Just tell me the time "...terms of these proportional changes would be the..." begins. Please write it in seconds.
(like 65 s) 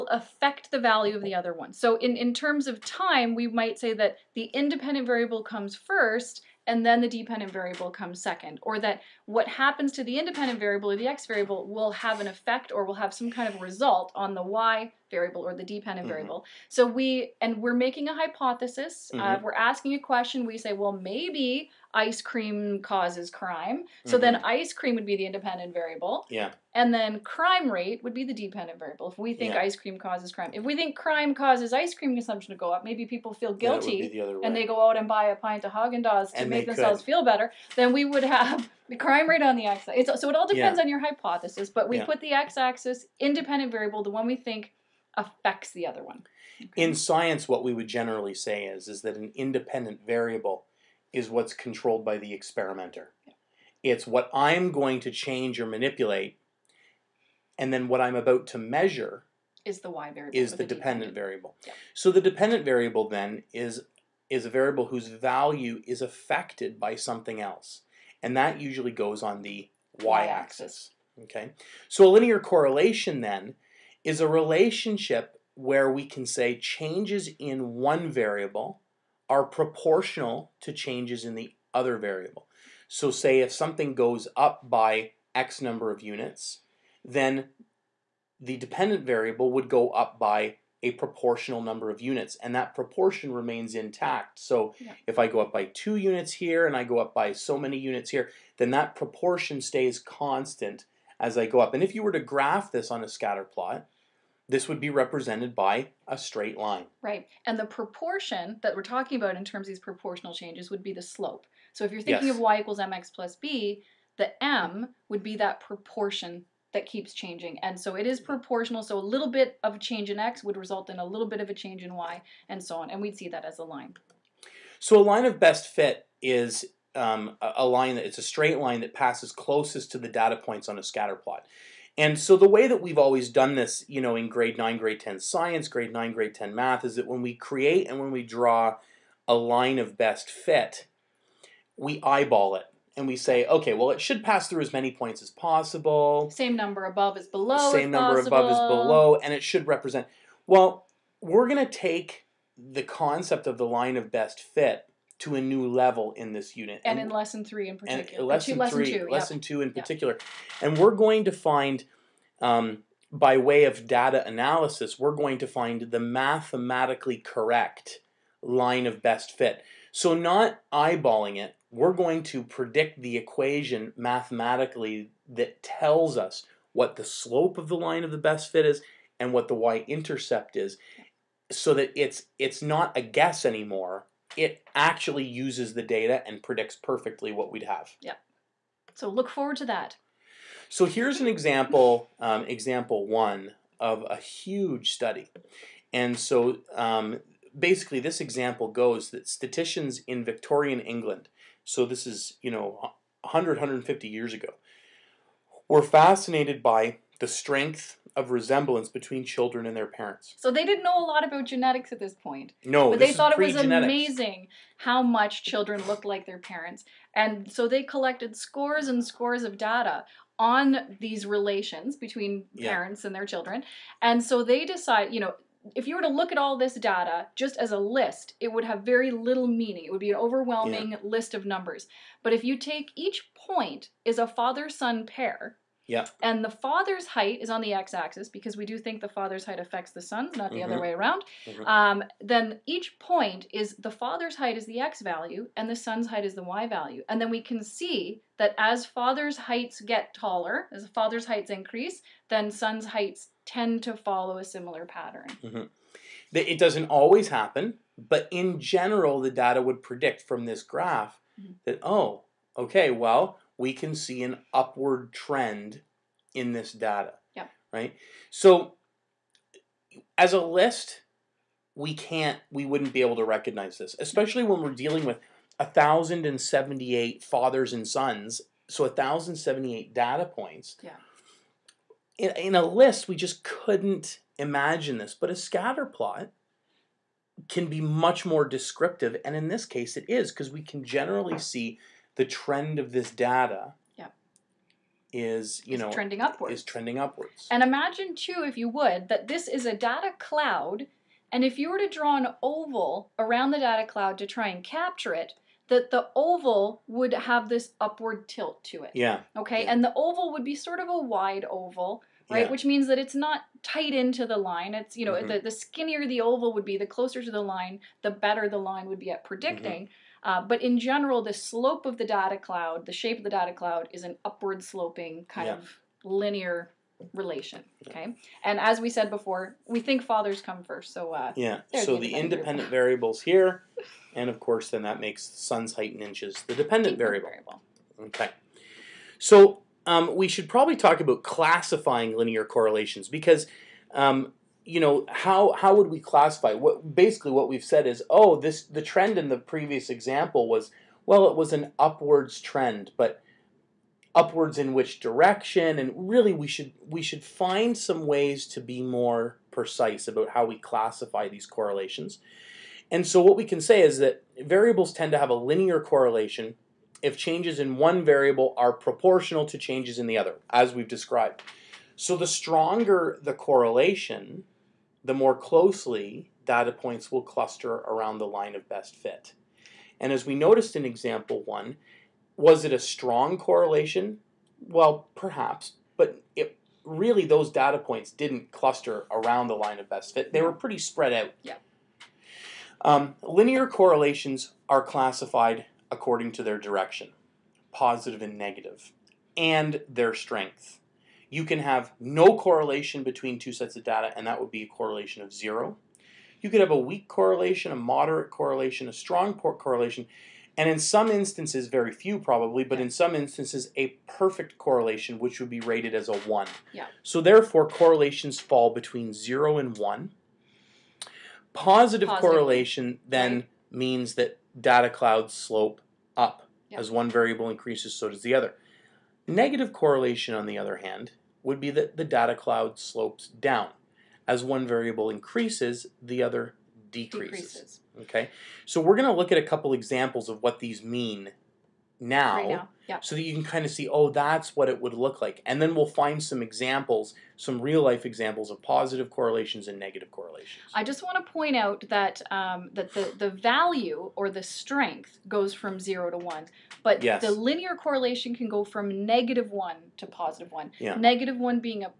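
109 s.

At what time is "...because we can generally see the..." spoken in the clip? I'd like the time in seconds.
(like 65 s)
290 s.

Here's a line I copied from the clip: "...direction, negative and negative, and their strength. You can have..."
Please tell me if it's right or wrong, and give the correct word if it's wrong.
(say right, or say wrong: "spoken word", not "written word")
wrong: "positive", not "negative".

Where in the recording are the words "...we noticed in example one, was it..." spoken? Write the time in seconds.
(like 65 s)
380 s.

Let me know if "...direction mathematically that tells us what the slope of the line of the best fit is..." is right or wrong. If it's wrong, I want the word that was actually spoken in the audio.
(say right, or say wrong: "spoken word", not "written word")
wrong: "equation", not "direction".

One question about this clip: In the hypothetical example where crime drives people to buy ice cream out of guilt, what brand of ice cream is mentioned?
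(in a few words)
Haagen Dazs.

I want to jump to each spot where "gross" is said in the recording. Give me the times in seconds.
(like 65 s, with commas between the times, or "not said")
not said.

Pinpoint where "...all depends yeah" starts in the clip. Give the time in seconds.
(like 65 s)
40 s.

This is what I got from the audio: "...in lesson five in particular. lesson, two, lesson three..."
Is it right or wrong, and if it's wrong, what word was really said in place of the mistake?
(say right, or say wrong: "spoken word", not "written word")
wrong: "three", not "five".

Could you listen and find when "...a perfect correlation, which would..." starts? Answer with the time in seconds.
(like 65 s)
413 s.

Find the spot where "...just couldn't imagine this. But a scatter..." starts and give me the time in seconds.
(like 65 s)
283 s.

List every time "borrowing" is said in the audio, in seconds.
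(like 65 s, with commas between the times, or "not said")
not said.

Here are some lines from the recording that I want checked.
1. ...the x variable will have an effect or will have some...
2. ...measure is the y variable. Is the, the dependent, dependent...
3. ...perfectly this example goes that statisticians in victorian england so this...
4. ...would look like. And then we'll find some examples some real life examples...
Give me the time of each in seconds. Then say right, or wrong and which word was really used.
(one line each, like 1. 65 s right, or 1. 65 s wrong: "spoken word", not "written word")
1. 10 s right
2. 58 s right
3. 197 s wrong: "basically", not "perfectly"
4. 444 s right.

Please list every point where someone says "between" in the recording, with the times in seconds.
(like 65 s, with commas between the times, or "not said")
208 s, 221 s, 403 s, 418 s.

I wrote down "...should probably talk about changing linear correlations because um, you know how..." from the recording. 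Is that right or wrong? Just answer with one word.
wrong.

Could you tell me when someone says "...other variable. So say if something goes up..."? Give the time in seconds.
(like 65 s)
81 s.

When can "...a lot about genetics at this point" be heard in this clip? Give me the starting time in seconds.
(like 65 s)
210 s.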